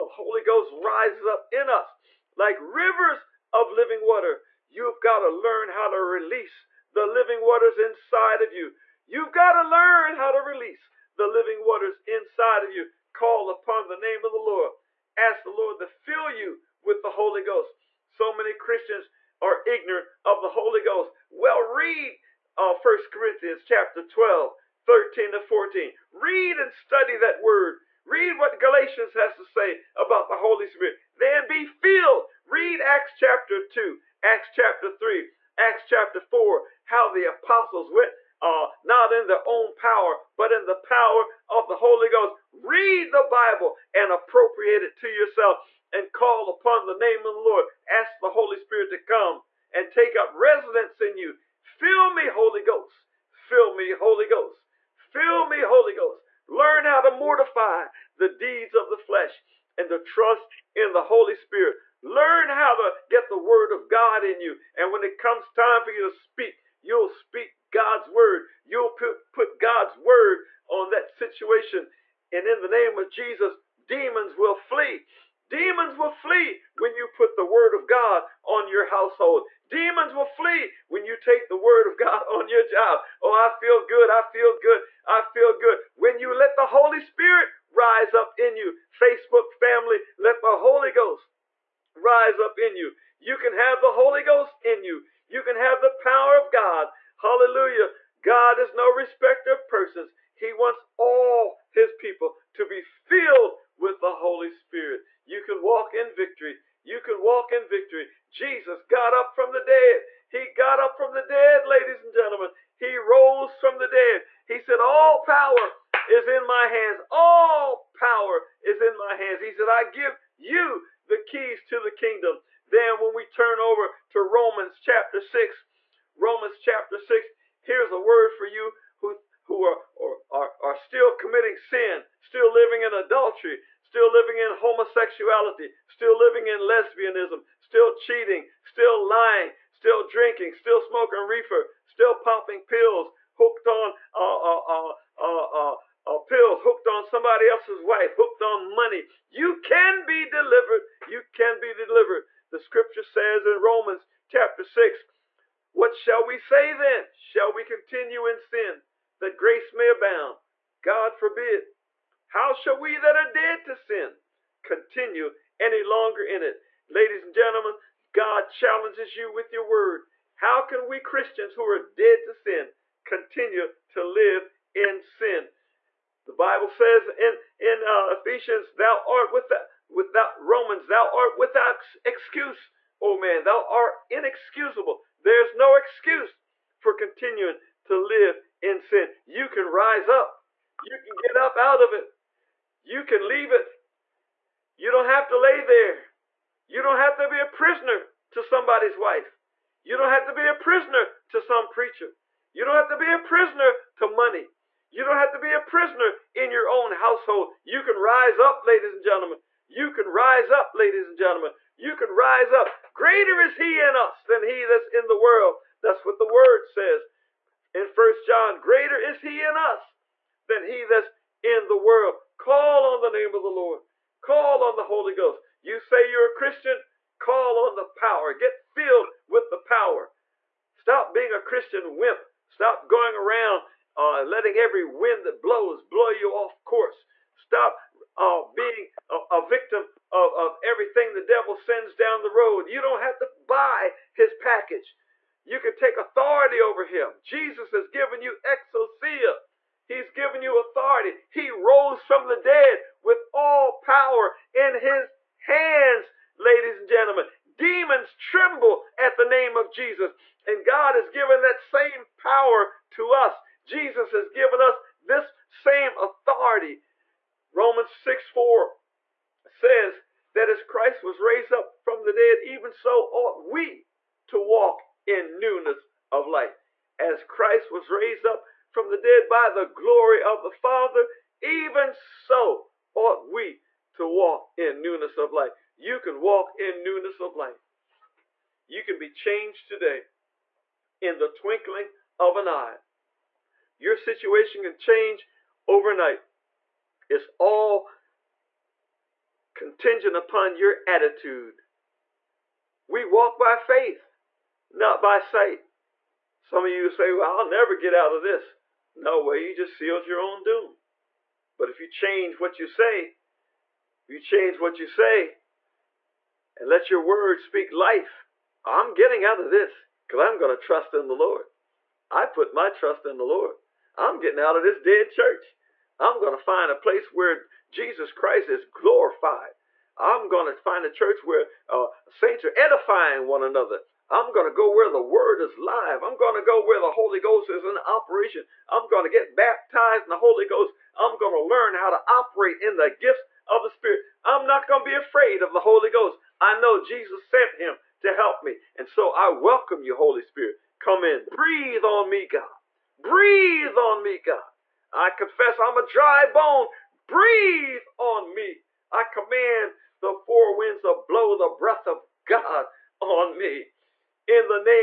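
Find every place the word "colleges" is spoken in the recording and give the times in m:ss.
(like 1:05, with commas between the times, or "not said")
not said.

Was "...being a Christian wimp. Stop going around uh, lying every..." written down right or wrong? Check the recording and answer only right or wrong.
wrong.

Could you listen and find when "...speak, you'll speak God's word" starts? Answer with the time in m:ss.
1:06.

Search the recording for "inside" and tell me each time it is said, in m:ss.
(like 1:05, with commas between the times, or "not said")
0:07, 0:12.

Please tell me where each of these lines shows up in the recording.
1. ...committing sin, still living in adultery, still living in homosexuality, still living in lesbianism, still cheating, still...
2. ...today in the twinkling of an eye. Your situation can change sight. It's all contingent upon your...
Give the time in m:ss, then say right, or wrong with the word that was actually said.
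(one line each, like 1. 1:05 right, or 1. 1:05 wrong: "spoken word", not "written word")
1. 2:11 right
2. 4:49 wrong: "overnight", not "sight".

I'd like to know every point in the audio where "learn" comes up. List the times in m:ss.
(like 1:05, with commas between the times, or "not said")
0:05, 0:09, 0:56, 1:02, 5:41.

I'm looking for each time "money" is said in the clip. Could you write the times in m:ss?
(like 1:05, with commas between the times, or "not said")
2:28, 3:24.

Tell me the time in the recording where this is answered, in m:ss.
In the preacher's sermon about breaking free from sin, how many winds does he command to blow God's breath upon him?
6:00.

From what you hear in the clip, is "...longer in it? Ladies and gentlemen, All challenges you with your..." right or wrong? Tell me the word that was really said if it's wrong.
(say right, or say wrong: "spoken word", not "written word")
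wrong: "God", not "All".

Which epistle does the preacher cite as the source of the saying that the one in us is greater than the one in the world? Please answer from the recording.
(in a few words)
First John.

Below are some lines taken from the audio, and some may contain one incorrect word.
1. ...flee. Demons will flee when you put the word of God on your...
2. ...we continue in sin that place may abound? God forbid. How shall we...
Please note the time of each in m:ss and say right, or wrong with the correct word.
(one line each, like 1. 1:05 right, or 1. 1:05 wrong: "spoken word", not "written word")
1. 1:14 right
2. 2:37 wrong: "grace", not "place".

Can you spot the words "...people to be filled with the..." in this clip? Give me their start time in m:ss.
1:41.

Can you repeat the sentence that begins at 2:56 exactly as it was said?
The Bible says in, in uh, Ephesians, thou art without, without Romans, thou art without excuse, O oh man, thou art inexcusable.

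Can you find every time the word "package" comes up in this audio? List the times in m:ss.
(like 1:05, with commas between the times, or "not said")
4:04.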